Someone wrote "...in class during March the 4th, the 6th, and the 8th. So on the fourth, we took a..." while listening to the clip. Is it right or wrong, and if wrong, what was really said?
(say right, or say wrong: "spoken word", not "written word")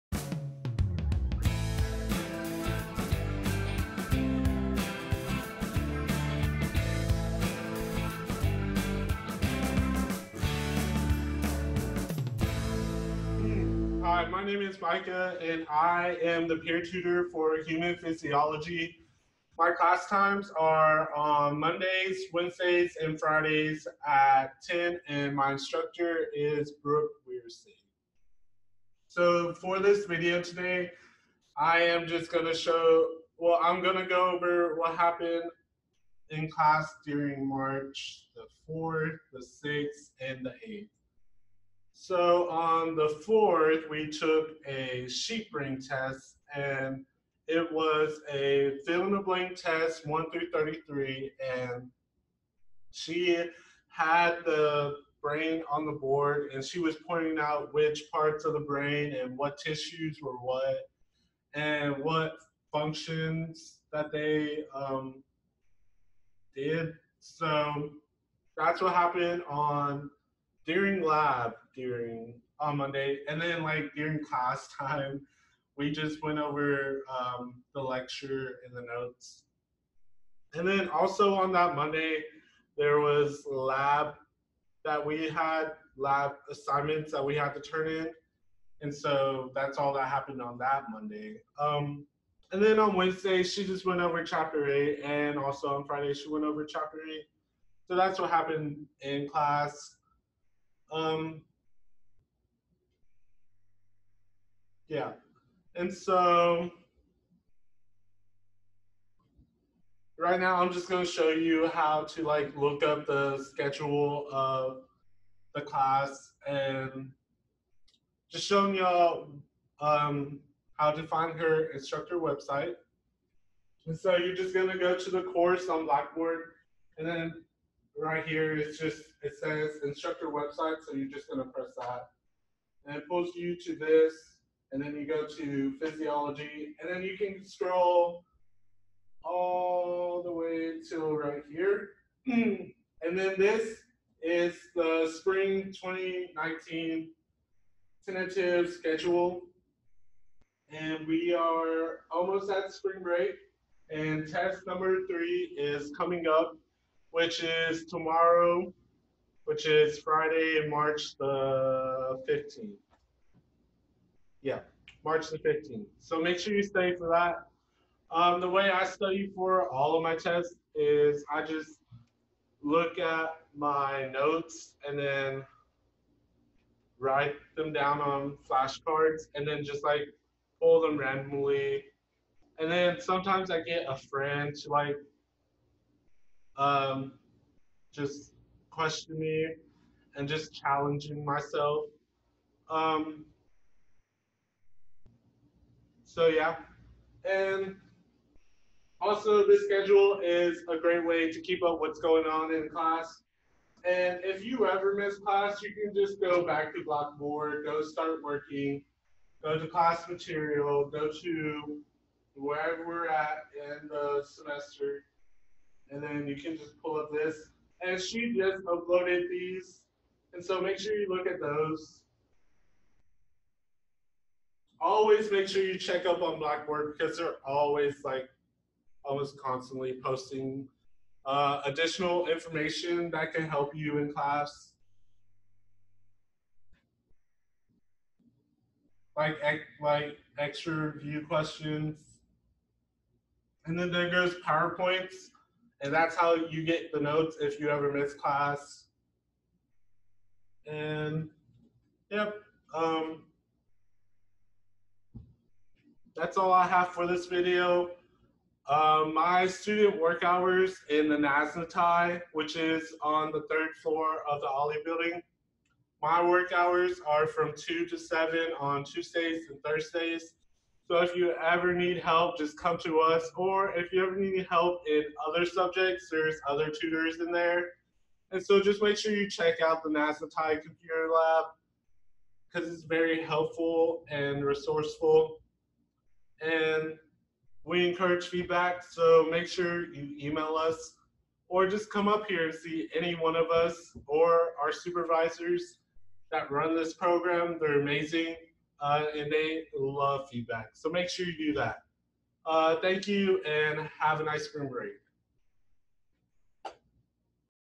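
right.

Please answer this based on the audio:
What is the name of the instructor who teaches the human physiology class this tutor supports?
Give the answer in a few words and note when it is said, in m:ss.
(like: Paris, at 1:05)
Brooke Weirstein, at 0:26.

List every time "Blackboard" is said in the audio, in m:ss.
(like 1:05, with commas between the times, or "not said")
2:05, 3:26, 3:46.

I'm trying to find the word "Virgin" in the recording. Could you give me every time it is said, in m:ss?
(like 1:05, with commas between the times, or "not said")
not said.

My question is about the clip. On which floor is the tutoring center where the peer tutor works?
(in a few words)
3rd floor.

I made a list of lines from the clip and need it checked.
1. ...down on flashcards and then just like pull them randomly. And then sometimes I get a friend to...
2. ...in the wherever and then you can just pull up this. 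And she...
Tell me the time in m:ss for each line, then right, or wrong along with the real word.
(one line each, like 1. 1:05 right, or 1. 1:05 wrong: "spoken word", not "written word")
1. 2:57 right
2. 3:33 wrong: "semester", not "wherever".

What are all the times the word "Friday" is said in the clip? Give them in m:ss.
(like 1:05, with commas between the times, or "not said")
0:23, 1:35, 2:39.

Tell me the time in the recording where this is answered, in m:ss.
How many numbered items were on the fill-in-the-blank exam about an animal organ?
0:50.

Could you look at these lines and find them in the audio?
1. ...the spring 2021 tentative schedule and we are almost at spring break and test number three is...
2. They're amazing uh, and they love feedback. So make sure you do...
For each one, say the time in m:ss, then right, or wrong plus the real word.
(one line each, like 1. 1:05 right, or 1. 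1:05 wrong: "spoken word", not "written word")
1. 2:24 wrong: "2019", not "2021"
2. 4:57 right.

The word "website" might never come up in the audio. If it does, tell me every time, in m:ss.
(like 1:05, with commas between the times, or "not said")
2:02, 2:10.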